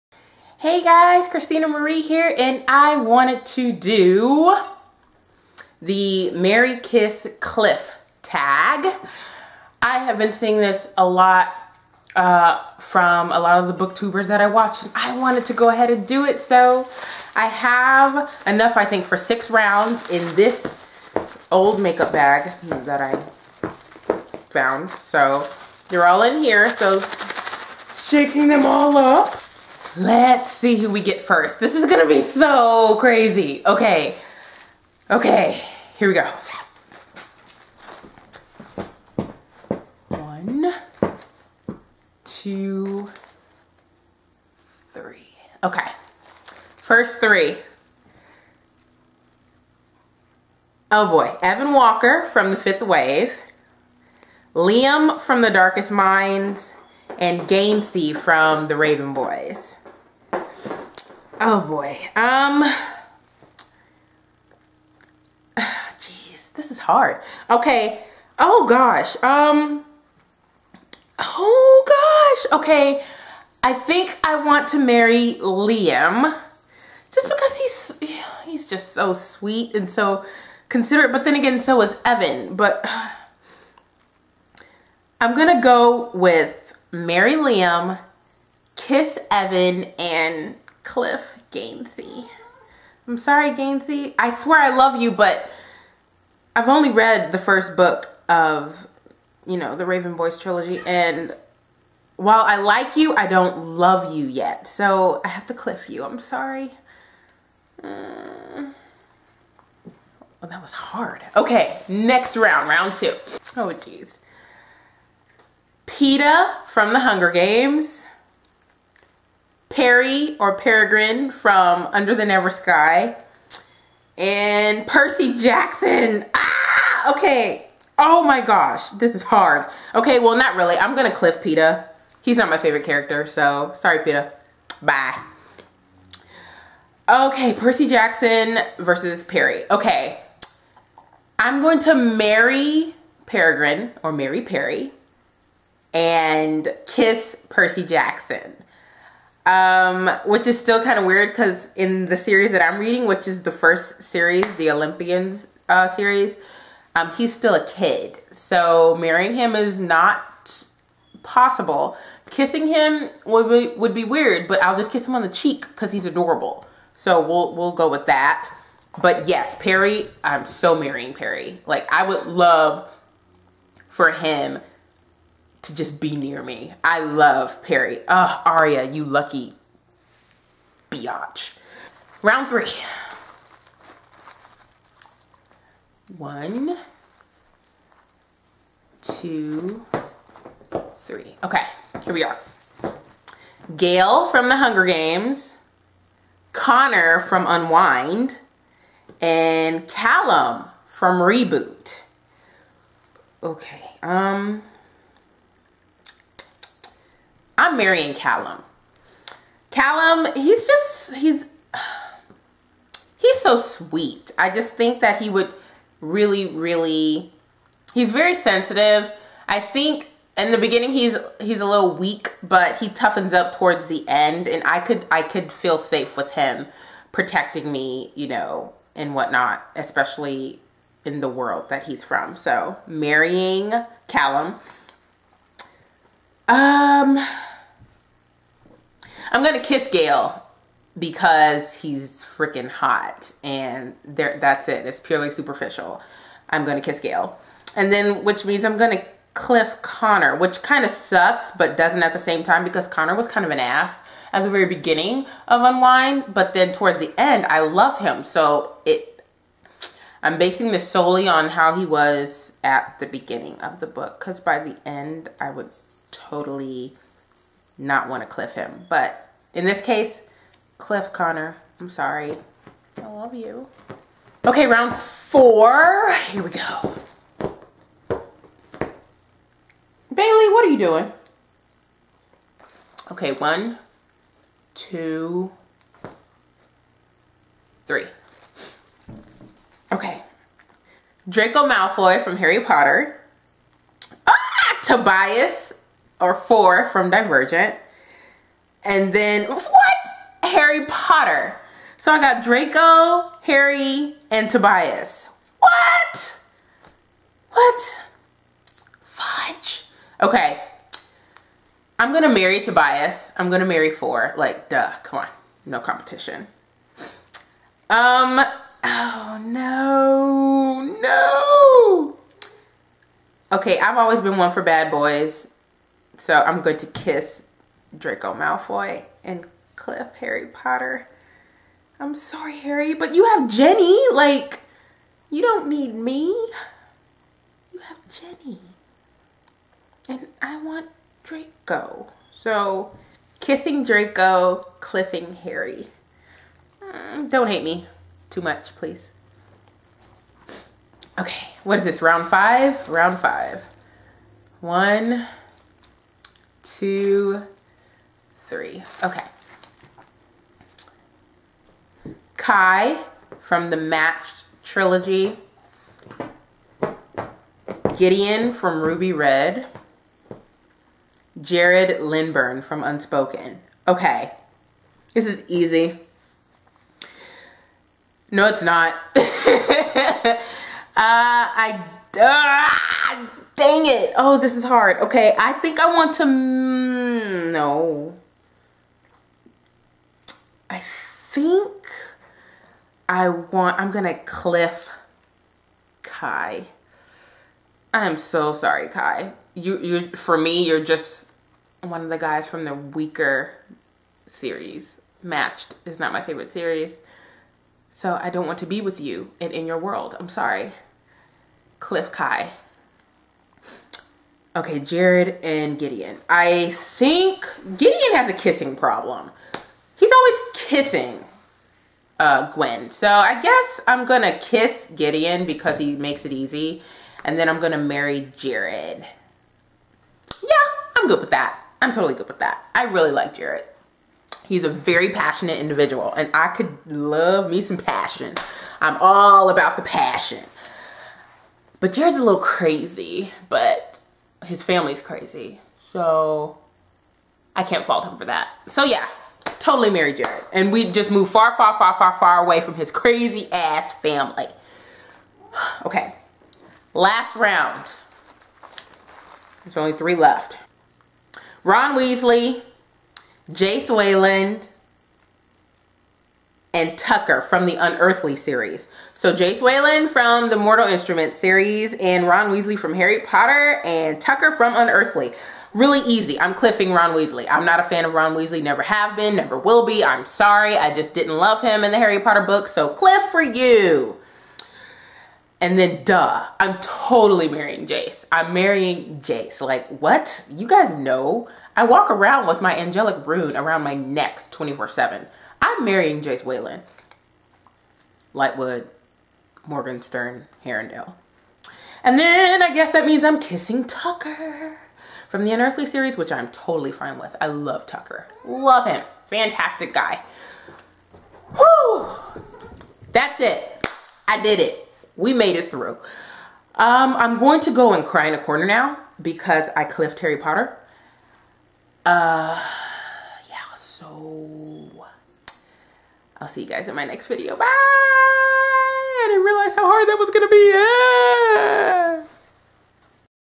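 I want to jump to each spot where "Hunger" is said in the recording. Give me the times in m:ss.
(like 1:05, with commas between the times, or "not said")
1:56, 3:14.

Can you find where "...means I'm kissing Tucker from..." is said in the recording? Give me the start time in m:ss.
8:23.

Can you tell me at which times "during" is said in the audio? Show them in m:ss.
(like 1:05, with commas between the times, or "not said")
not said.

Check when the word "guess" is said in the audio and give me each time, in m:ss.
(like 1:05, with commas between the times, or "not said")
7:03, 8:22.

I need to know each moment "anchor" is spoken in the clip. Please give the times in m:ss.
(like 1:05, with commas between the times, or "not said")
not said.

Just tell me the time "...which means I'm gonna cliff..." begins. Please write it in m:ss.
4:08.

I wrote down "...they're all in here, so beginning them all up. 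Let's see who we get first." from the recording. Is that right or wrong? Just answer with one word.
wrong.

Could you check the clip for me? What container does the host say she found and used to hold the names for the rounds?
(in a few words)
old makeup bag.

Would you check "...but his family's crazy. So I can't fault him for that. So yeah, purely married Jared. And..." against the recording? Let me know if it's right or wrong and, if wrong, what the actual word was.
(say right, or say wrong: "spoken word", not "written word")
wrong: "totally", not "purely".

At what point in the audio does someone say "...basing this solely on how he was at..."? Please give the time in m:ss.
4:20.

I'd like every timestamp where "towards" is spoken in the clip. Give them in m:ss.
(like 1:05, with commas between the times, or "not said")
3:43, 4:16.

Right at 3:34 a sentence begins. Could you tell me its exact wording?
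I just think that he would really, really, he's very sensitive.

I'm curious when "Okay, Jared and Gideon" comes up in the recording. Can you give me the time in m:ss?
6:54.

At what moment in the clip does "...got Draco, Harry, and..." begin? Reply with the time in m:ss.
5:02.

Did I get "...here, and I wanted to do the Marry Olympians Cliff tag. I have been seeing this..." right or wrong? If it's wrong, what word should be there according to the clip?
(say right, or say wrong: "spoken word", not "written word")
wrong: "Kiss", not "Olympians".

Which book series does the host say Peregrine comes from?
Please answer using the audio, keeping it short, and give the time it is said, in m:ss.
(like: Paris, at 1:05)
Under the Never Sky, at 2:01.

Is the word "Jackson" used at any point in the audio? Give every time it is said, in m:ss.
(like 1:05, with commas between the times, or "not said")
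2:05, 2:17, 2:27.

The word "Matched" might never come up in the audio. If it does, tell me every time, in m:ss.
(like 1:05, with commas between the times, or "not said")
6:03, 6:45.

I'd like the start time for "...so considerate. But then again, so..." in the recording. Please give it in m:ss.
1:19.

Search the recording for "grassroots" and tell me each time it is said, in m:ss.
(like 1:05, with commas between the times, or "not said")
not said.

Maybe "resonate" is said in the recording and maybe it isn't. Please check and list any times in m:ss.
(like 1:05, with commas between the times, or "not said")
not said.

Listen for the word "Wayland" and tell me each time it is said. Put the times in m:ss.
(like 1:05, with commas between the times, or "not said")
7:43, 7:49, 8:16.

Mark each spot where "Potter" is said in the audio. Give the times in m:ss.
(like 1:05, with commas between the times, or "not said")
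4:52, 5:00, 5:30, 7:53, 8:02, 8:40.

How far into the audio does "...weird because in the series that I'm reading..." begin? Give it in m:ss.
2:31.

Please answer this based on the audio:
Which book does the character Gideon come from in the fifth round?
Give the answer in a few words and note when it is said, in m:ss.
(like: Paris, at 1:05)
Ruby Red, at 6:08.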